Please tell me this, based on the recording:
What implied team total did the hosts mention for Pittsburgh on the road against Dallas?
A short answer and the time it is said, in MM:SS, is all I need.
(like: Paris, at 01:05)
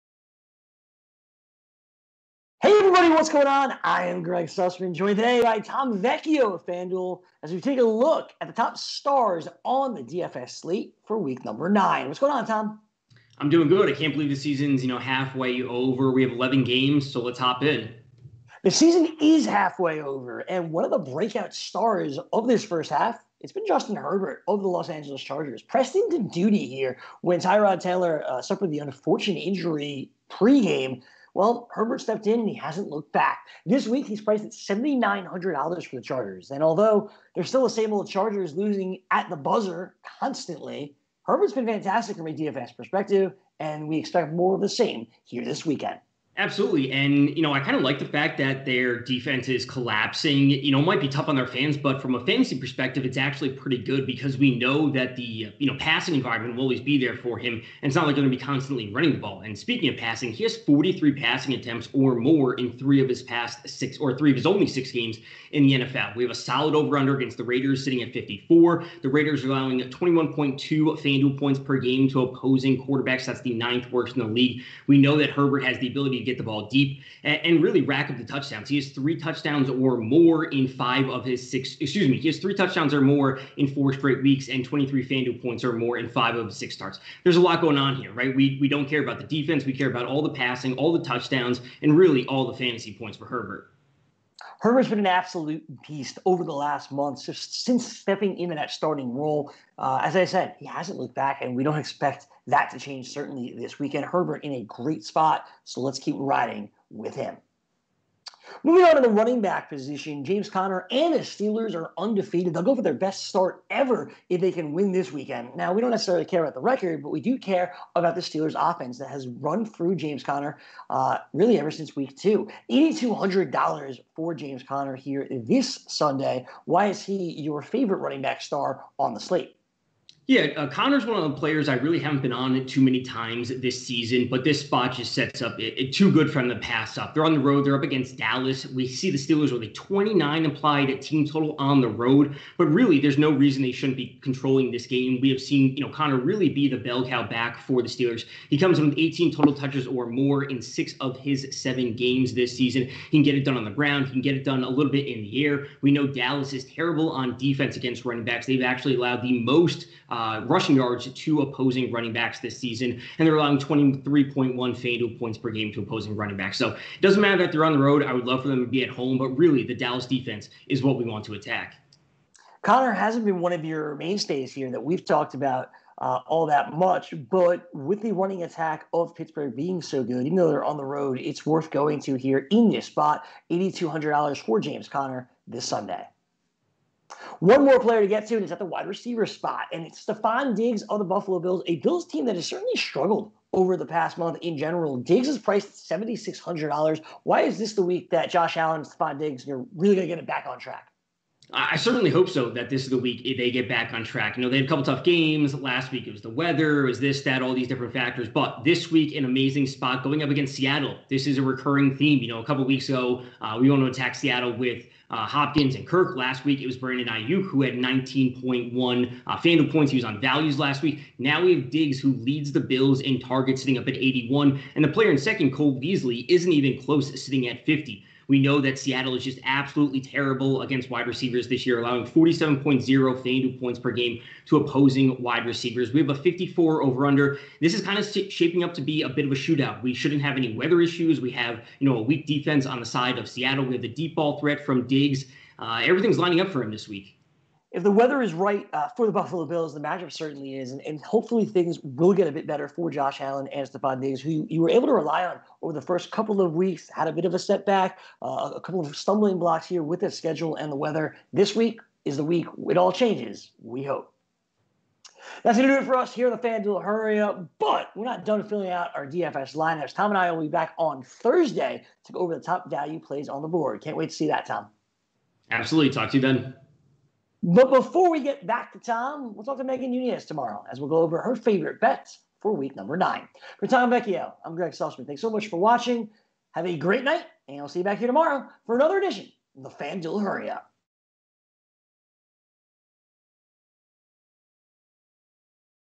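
29, at 02:19.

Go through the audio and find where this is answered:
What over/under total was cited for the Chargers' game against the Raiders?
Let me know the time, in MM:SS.
01:07.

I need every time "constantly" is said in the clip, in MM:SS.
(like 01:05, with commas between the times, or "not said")
00:40, 00:58.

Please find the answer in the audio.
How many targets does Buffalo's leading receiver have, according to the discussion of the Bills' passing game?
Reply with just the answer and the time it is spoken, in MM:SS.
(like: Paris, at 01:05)
81, at 03:43.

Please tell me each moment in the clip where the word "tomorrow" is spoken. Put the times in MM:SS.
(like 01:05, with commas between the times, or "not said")
04:40, 04:48.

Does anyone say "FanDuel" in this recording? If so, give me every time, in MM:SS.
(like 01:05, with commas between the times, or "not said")
00:06, 01:10, 01:25, 02:44, 03:39, 03:52, 04:26, 04:49.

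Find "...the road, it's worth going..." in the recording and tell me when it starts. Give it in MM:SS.
03:00.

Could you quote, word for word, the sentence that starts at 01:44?
Herbert in a great spot, so let's keep riding with him.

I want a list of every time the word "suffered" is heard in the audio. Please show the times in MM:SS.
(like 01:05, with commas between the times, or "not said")
00:28.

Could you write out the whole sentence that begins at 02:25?
We have seen, you know, Conner really be the bell cow back for the Steelers.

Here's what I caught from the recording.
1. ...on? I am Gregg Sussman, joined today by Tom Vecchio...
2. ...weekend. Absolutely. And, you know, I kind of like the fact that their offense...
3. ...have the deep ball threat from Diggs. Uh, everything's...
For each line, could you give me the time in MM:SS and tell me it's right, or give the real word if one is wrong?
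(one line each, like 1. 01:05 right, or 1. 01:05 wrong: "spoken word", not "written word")
1. 00:03 right
2. 00:45 wrong: "defense", not "offense"
3. 04:03 right.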